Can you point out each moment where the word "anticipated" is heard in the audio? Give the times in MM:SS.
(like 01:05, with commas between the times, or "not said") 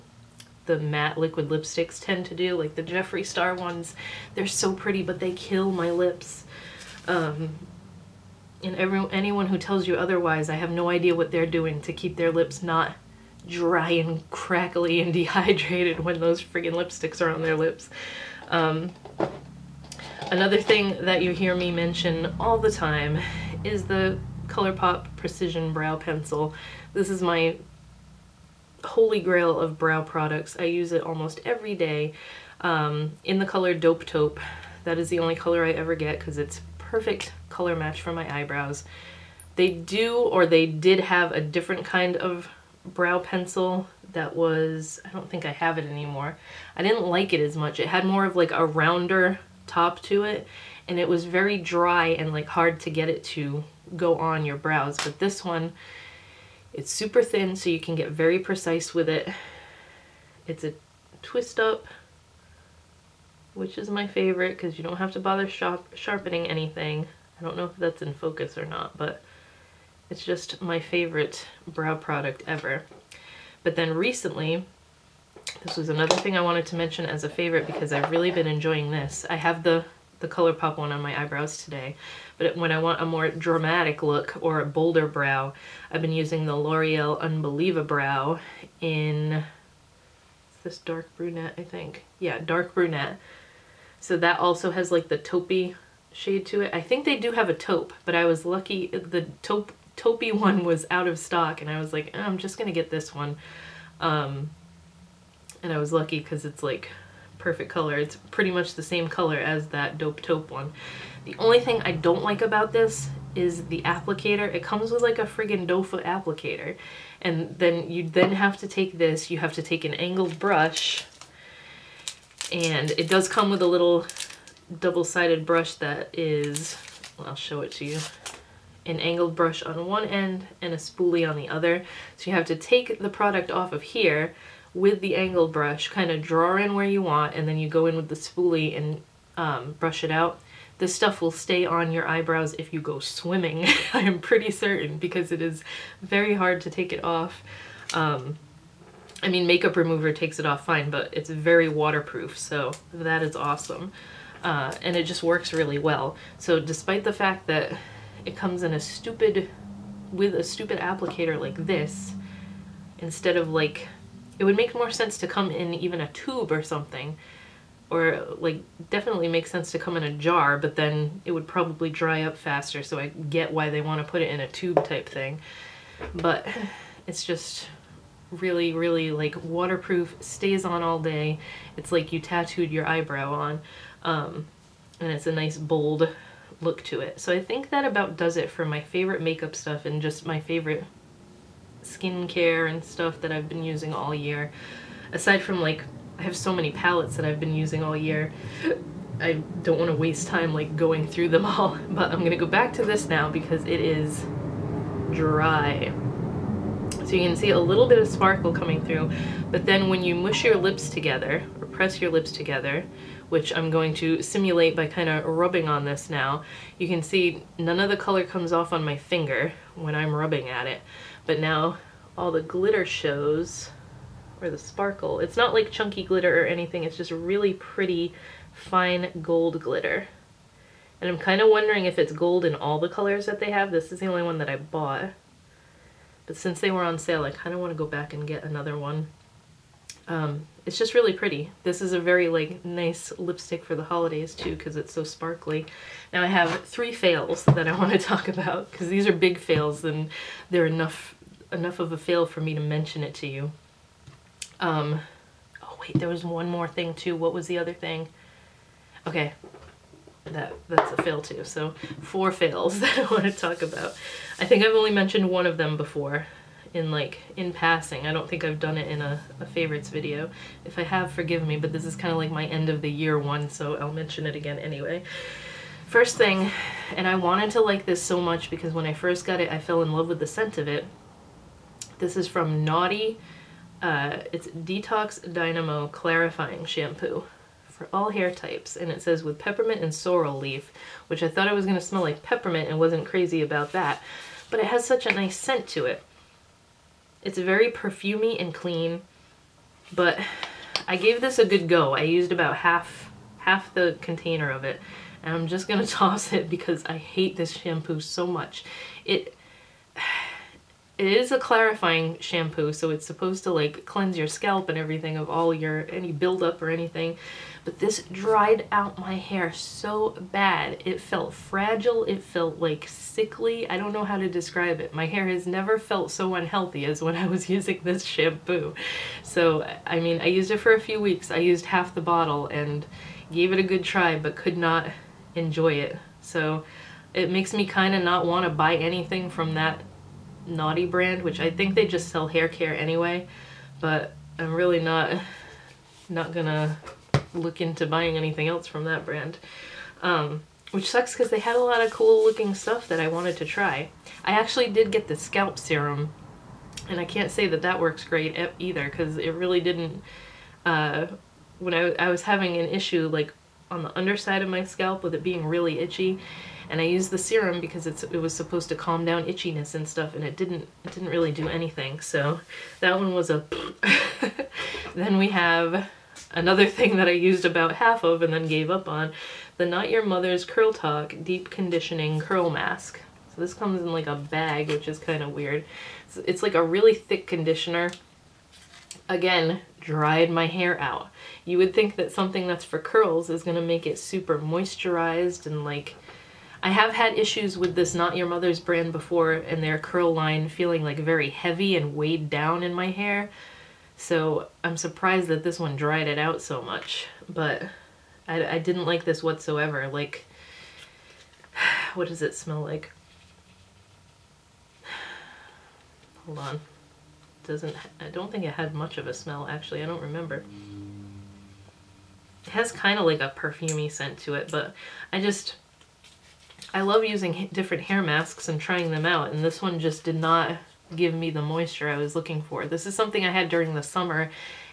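not said.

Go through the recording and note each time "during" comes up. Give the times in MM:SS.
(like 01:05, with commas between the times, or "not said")
07:13.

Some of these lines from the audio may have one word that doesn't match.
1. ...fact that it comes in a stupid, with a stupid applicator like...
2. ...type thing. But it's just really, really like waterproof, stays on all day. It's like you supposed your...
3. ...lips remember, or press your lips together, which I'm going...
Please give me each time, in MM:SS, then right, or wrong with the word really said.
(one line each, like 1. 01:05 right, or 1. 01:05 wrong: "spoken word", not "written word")
1. 02:37 right
2. 02:54 wrong: "tattooed", not "supposed"
3. 03:30 wrong: "together", not "remember".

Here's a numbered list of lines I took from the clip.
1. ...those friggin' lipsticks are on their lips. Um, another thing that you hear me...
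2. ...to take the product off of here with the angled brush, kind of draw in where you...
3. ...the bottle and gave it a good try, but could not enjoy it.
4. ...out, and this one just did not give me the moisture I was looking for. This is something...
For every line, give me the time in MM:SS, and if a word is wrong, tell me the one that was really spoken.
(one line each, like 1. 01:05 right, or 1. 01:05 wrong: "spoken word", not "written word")
1. 00:16 right
2. 02:12 right
3. 05:31 right
4. 07:09 right.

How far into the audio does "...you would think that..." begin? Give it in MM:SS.
06:31.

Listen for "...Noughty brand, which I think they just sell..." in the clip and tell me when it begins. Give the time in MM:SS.
05:40.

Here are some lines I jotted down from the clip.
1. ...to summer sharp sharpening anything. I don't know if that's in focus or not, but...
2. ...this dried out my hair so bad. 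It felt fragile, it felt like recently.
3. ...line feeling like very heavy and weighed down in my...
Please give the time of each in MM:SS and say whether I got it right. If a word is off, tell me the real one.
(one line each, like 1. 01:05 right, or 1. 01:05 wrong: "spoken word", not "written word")
1. 01:05 wrong: "bother", not "summer"
2. 05:17 wrong: "sickly", not "recently"
3. 06:40 right.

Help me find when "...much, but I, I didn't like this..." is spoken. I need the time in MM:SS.
06:46.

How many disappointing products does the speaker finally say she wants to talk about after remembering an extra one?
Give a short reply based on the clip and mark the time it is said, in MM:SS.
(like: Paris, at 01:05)
4, at 04:22.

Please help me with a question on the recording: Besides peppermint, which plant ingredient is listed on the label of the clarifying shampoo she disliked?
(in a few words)
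sorrel leaf.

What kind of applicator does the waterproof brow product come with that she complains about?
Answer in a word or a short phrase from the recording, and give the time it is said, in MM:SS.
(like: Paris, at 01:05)
doe foot applicator, at 01:55.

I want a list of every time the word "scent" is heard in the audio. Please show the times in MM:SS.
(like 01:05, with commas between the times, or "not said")
04:40, 04:55, 07:03.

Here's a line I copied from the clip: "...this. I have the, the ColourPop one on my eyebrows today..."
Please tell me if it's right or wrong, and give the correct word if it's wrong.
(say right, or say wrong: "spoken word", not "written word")
right.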